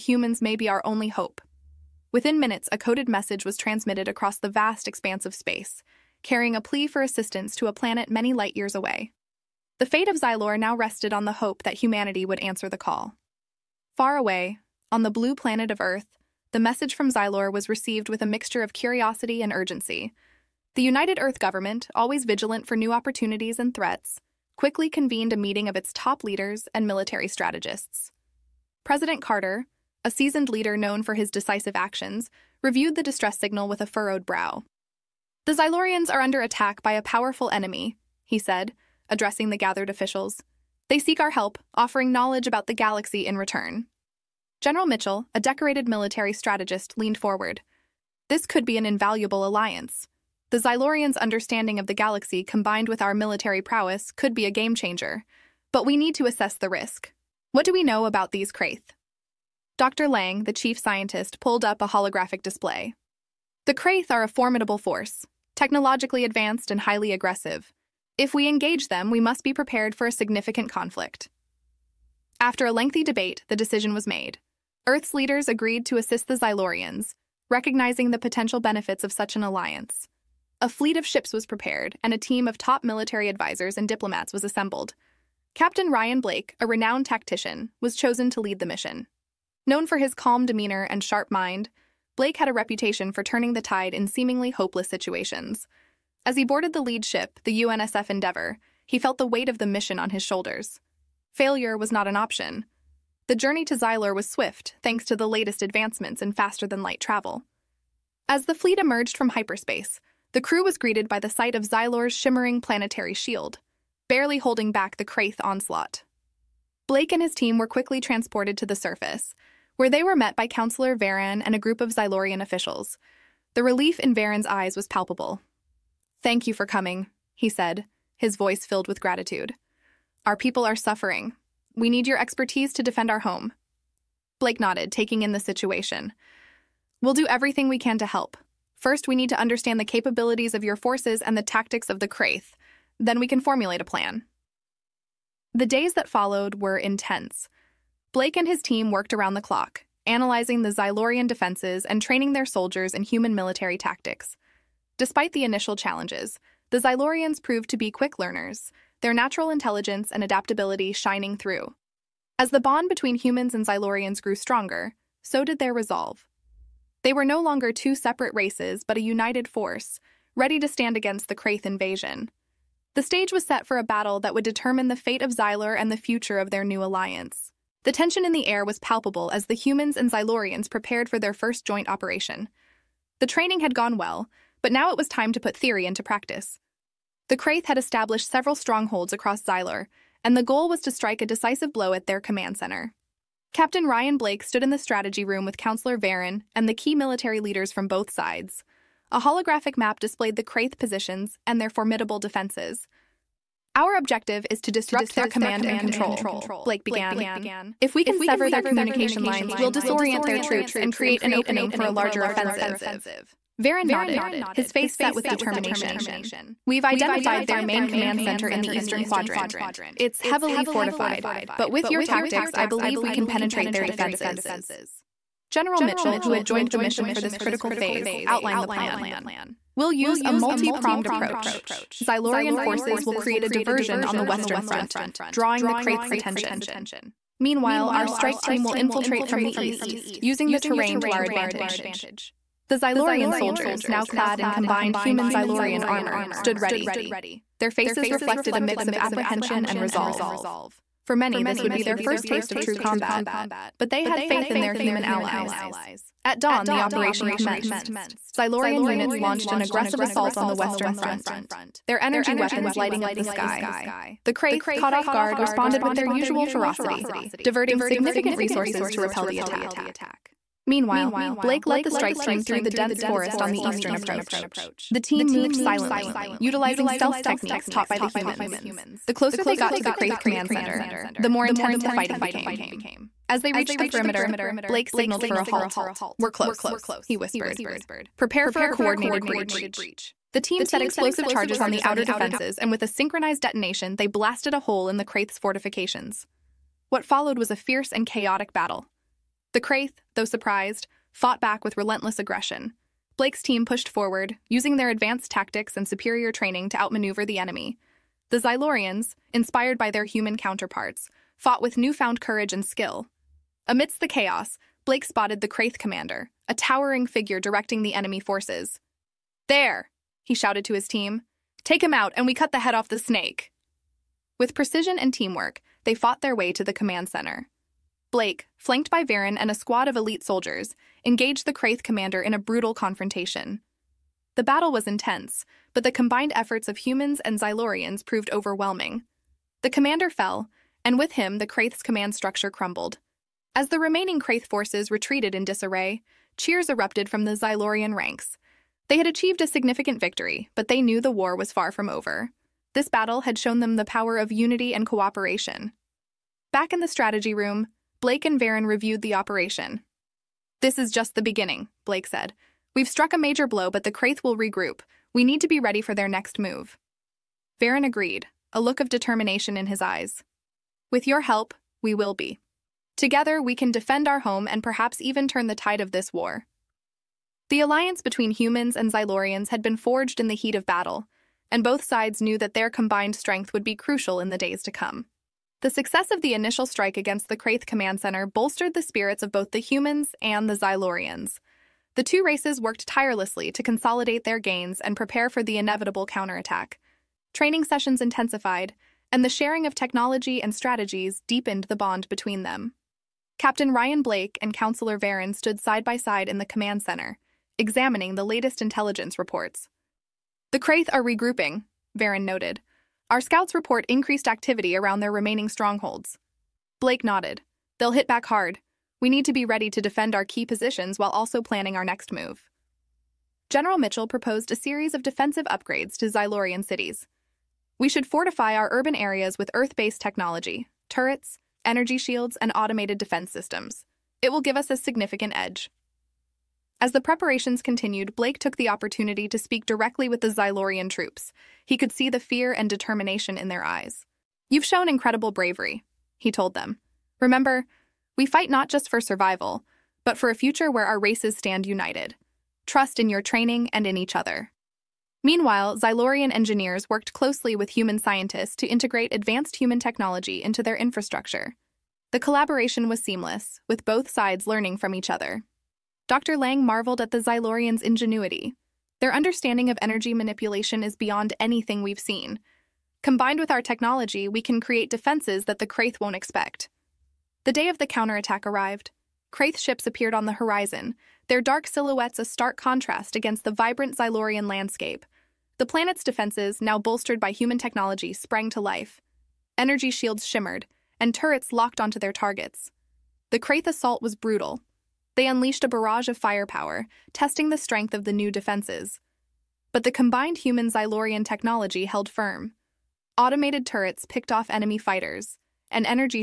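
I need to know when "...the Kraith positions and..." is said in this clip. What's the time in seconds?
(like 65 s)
200 s.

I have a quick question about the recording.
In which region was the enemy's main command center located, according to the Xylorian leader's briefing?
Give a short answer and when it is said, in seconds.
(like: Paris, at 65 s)
Eastern Quadrant, at 218 s.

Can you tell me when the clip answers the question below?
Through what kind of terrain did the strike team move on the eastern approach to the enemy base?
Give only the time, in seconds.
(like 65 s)
272 s.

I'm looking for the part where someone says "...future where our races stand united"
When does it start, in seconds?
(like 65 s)
450 s.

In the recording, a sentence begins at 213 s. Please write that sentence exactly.
Varen nodded, his face set with determination.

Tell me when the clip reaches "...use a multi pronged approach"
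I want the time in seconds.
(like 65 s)
229 s.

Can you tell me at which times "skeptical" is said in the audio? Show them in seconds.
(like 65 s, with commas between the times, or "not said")
not said.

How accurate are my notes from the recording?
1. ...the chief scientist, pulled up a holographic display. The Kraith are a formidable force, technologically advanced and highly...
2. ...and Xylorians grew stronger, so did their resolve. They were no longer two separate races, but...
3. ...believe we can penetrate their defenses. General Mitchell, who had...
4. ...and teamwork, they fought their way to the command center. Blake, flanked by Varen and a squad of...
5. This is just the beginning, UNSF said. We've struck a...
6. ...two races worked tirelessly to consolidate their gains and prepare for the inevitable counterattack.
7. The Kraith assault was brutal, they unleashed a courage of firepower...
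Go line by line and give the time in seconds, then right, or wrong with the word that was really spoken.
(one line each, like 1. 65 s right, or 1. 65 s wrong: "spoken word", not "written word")
1. 60 s right
2. 163 s right
3. 222 s right
4. 324 s right
5. 360 s wrong: "Blake", not "UNSF"
6. 392 s right
7. 493 s wrong: "barrage", not "courage".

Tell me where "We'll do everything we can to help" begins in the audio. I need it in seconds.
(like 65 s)
137 s.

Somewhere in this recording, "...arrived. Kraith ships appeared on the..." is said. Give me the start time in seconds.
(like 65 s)
478 s.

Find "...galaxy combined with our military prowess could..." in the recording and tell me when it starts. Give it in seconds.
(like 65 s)
51 s.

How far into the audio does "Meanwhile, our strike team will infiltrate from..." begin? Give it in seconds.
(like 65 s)
237 s.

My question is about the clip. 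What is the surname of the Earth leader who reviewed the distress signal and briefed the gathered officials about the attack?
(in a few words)
Carter.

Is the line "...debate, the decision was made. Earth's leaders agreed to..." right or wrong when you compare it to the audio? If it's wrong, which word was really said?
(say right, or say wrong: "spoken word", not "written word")
right.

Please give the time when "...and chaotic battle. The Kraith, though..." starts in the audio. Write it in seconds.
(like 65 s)
297 s.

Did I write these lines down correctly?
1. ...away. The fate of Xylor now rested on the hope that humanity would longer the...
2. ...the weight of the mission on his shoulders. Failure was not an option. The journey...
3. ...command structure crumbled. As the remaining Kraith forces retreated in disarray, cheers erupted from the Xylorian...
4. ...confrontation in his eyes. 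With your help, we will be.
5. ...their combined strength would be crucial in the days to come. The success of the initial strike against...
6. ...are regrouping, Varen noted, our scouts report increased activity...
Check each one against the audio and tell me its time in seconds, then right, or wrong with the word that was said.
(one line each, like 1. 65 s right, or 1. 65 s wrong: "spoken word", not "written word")
1. 8 s wrong: "answer", not "longer"
2. 99 s right
3. 341 s right
4. 368 s wrong: "determination", not "confrontation"
5. 382 s right
6. 410 s right.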